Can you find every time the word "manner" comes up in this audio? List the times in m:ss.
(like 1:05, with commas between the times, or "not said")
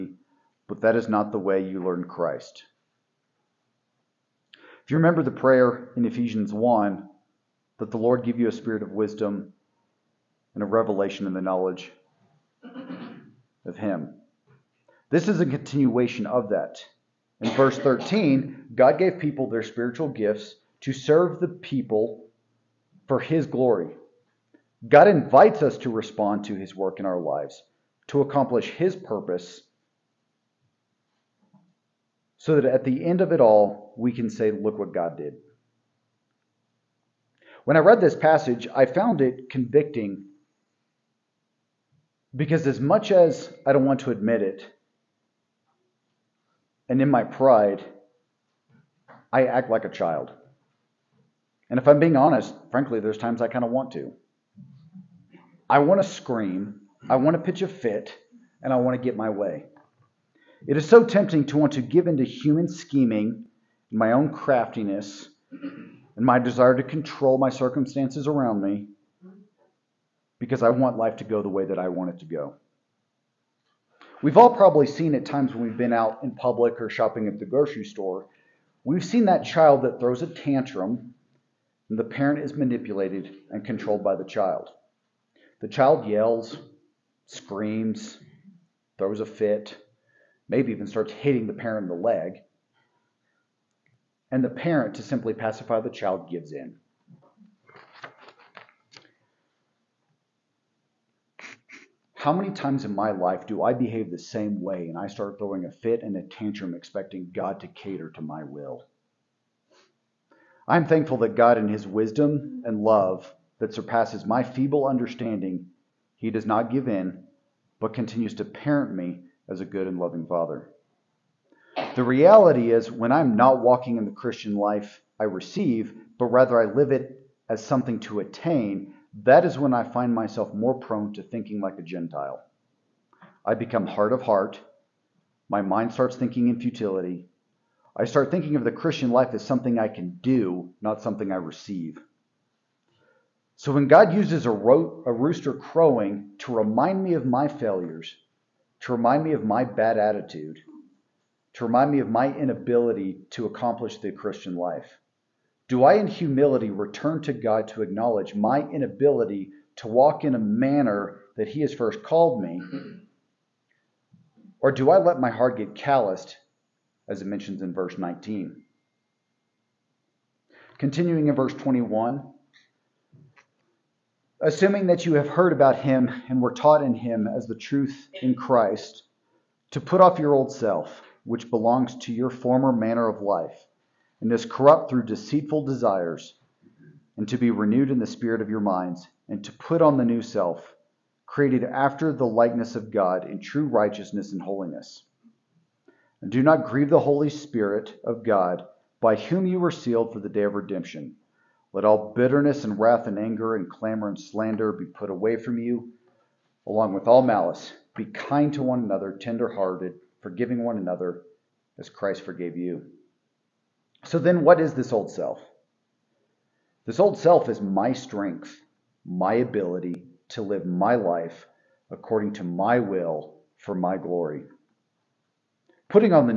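2:40, 3:02.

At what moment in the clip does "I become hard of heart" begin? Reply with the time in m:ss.
2:13.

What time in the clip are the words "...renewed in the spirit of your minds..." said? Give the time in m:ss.
3:07.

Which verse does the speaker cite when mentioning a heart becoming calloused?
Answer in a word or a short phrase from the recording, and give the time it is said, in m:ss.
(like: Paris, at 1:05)
19, at 2:47.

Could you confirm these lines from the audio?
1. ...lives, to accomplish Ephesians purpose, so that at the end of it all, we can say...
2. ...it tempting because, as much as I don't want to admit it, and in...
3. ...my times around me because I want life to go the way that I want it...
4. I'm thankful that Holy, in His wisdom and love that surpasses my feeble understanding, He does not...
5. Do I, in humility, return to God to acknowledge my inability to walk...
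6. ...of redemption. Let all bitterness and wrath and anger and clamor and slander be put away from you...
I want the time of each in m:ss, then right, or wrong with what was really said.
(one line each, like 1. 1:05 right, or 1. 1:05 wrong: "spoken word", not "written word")
1. 0:27 wrong: "His", not "Ephesians"
2. 0:39 wrong: "convicting", not "tempting"
3. 1:07 wrong: "circumstances", not "times"
4. 1:50 wrong: "God", not "Holy"
5. 2:35 right
6. 3:20 right.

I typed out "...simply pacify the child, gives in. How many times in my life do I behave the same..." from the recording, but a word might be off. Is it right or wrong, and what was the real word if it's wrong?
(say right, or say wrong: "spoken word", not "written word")
right.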